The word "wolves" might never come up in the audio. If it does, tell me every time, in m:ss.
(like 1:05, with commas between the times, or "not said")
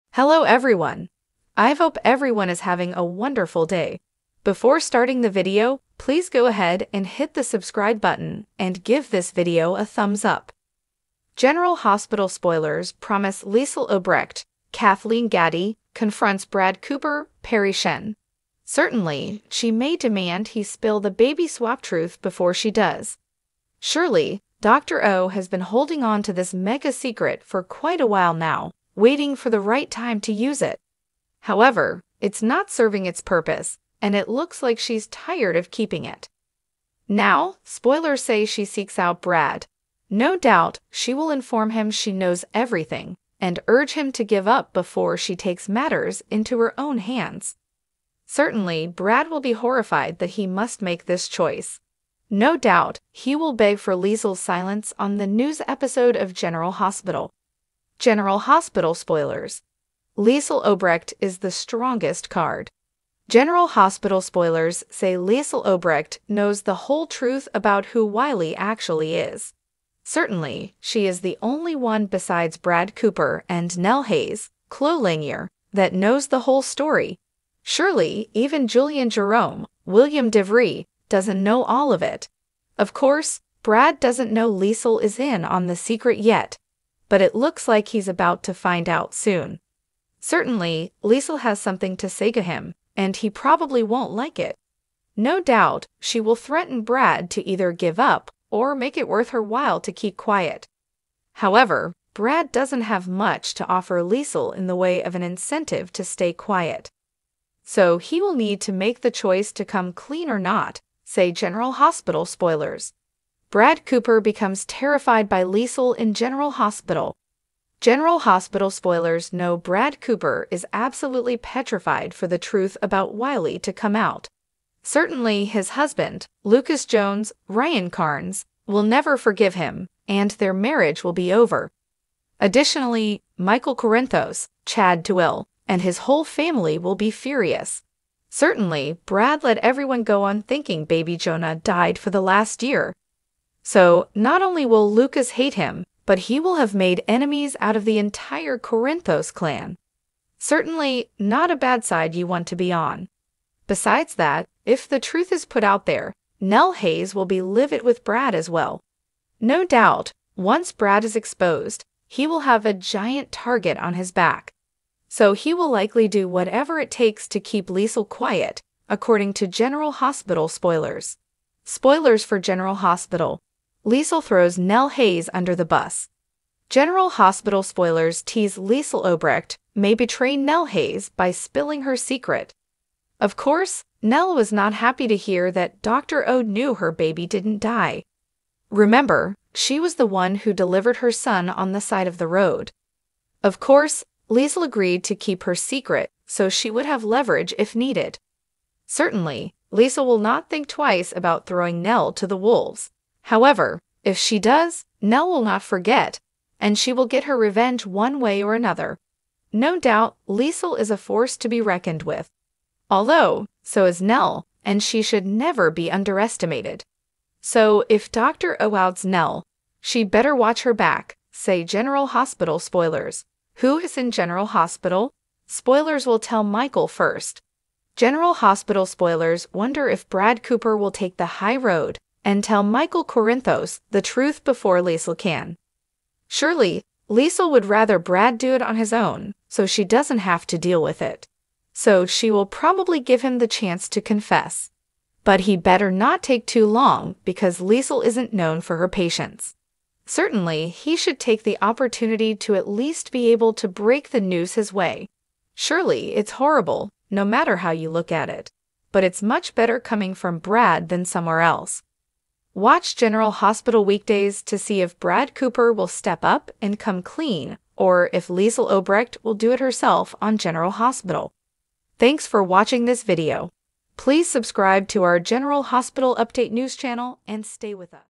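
3:22.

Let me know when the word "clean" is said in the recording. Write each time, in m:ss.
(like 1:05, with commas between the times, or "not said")
1:49, 4:27.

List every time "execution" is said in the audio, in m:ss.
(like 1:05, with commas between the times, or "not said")
not said.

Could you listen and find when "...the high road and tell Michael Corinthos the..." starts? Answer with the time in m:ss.
3:51.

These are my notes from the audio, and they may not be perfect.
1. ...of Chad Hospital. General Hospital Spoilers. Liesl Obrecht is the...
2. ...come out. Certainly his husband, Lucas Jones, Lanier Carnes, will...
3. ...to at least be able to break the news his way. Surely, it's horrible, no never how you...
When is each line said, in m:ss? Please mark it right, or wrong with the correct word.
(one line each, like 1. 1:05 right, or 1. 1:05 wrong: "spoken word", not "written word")
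1. 0:56 wrong: "General", not "Chad"
2. 2:03 wrong: "Ryan", not "Lanier"
3. 4:12 wrong: "matter", not "never".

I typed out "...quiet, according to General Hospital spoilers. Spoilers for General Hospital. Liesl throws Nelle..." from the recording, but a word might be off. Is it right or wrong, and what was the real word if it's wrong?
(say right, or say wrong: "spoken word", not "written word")
right.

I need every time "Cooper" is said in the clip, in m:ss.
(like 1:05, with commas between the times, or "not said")
0:16, 1:12, 1:53, 1:59, 3:50, 4:25.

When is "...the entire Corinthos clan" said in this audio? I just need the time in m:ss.
2:27.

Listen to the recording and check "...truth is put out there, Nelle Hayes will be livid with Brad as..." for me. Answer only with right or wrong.
right.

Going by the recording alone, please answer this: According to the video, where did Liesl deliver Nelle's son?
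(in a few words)
Side of the road.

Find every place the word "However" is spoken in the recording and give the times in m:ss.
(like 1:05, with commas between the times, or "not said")
0:31, 1:41, 3:23.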